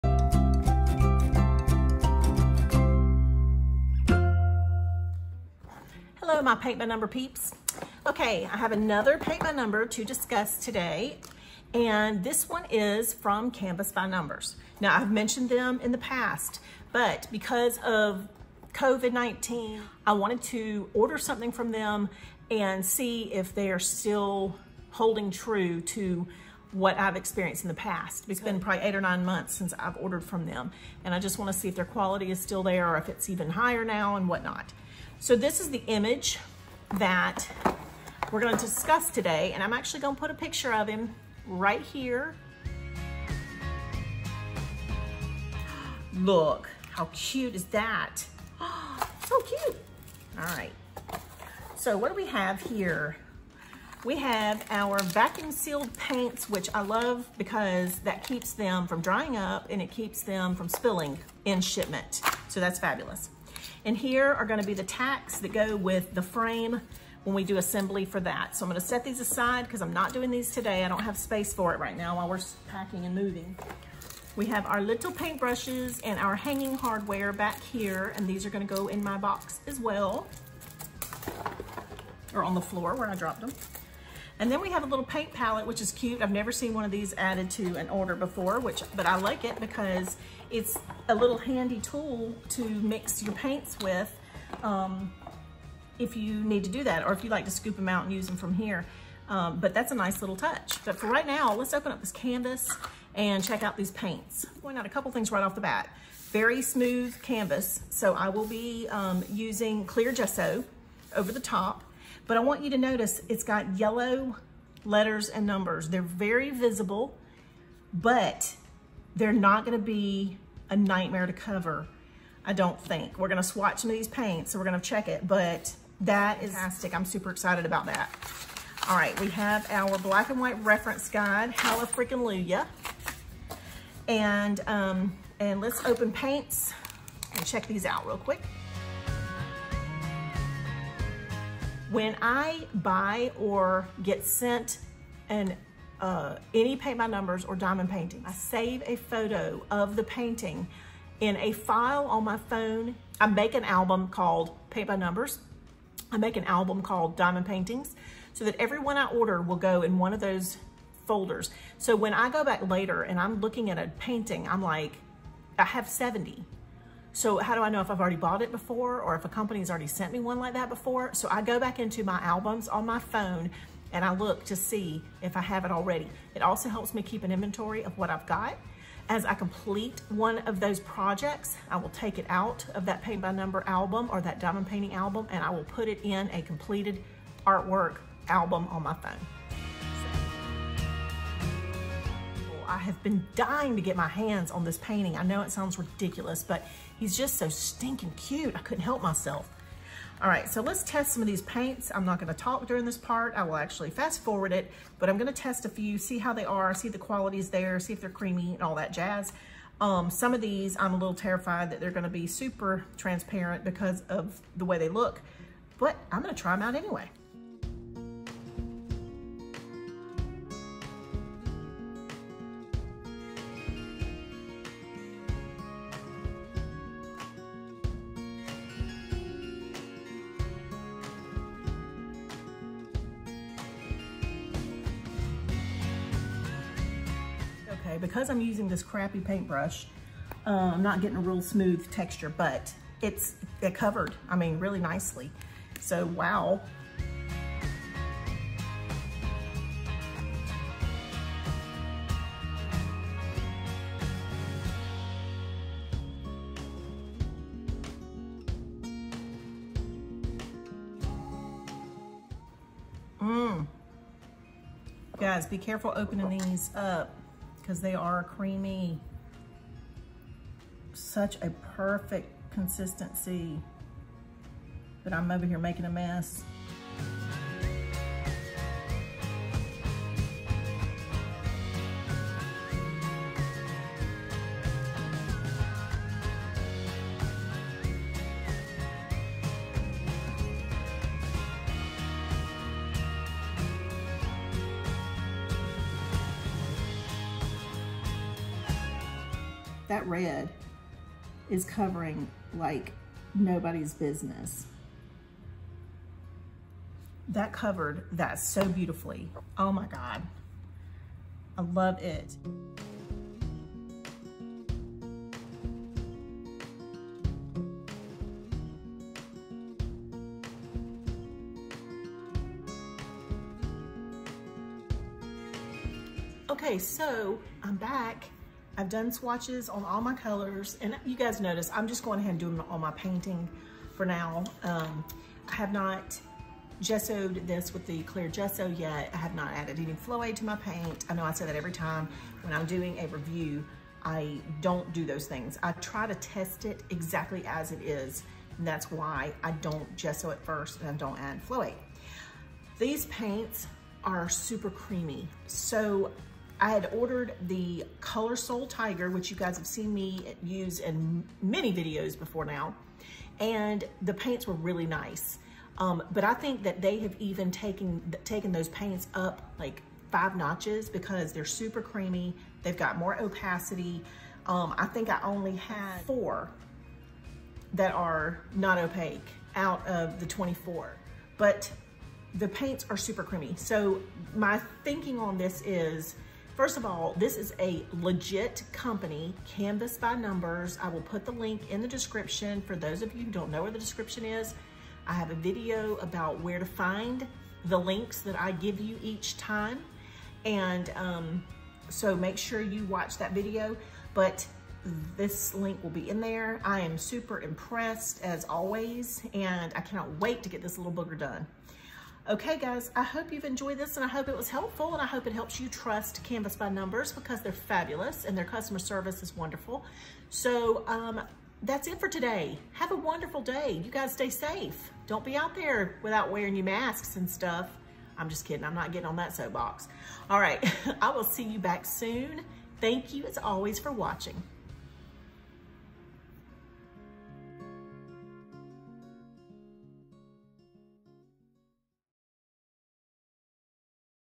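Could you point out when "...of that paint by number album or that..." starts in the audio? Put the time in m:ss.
3:02.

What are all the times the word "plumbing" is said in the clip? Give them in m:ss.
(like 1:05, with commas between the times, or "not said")
not said.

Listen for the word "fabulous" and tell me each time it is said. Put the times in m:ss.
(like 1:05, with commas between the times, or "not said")
1:02, 6:57.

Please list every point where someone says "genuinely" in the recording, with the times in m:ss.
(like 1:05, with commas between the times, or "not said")
not said.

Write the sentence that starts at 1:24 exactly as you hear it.
And then we have a little paint palette, which is cute.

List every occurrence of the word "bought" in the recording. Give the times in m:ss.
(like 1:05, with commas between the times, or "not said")
2:48.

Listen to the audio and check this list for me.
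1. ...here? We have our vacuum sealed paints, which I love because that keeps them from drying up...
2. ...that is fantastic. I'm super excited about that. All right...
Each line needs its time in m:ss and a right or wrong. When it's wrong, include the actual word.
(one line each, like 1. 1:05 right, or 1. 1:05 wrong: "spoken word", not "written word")
1. 0:52 right
2. 2:05 right.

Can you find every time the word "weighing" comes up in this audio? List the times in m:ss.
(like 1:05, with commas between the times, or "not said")
not said.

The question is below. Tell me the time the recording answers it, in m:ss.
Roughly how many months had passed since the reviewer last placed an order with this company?
0:28.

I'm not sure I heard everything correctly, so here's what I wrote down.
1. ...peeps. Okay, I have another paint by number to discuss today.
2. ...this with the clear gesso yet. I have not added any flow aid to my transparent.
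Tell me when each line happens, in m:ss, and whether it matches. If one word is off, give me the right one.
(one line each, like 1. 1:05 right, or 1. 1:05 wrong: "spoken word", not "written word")
1. 0:07 right
2. 5:37 wrong: "paint", not "transparent".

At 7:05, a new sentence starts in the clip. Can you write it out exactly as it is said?
Don't be out there without wearing your masks and stuff.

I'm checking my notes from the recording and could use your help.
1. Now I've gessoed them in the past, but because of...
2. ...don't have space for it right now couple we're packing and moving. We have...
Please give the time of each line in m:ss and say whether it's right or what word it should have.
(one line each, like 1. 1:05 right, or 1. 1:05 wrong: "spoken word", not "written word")
1. 0:14 wrong: "mentioned", not "gessoed"
2. 1:10 wrong: "while", not "couple".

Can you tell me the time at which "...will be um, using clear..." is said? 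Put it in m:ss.
1:48.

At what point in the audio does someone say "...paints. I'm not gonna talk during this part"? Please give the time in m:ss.
3:21.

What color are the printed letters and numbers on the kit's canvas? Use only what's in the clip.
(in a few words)
Yellow.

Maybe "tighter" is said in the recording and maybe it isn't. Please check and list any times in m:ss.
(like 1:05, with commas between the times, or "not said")
not said.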